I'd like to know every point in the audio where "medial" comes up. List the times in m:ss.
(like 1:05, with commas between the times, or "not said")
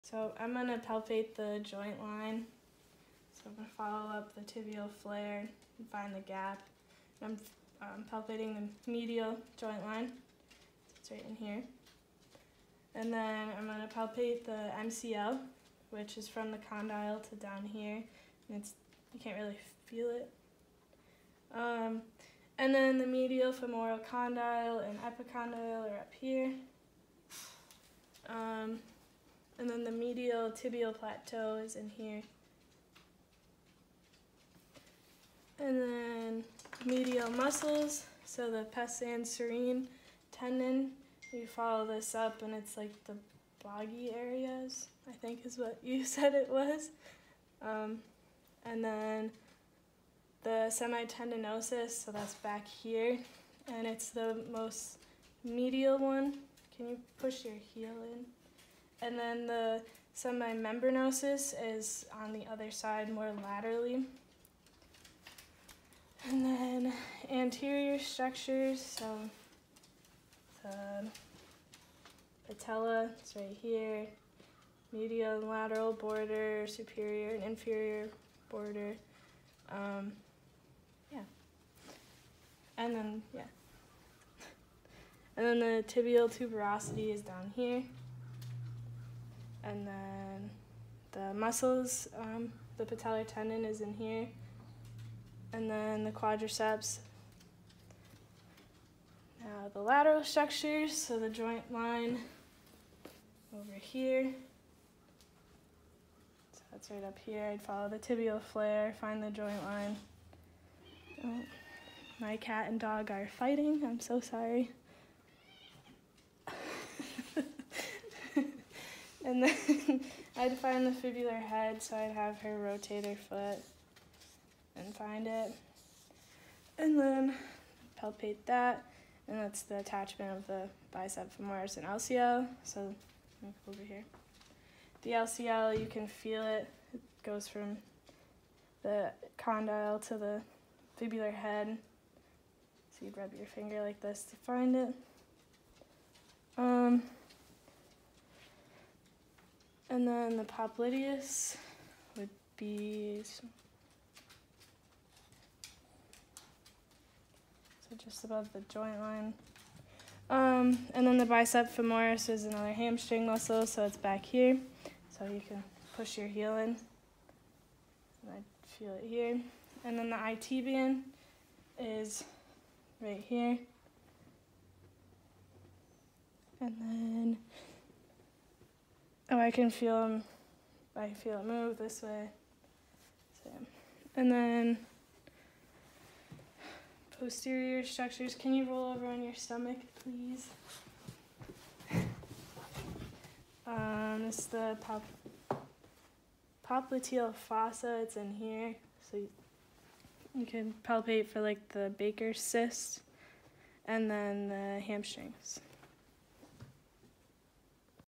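0:08, 0:23, 0:29, 0:36, 0:55, 1:14.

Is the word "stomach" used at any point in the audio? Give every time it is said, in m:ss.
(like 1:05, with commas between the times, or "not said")
3:09.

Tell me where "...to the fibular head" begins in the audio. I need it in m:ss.
2:20.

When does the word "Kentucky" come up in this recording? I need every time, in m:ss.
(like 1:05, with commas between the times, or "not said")
not said.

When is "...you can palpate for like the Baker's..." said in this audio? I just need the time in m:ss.
3:20.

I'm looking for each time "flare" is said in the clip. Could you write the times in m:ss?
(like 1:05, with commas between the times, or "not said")
0:05, 1:48.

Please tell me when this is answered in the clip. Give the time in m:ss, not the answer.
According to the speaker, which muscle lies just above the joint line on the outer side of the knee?
2:30.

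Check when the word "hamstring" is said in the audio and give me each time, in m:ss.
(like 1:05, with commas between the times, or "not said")
2:42, 3:24.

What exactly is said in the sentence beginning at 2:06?
And then palpate that, and that's the attachment of the bicep femoris and LCL.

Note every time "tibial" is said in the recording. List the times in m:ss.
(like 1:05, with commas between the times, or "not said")
0:04, 0:30, 1:25, 1:47.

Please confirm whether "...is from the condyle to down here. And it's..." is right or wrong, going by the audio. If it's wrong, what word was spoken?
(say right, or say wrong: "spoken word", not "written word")
right.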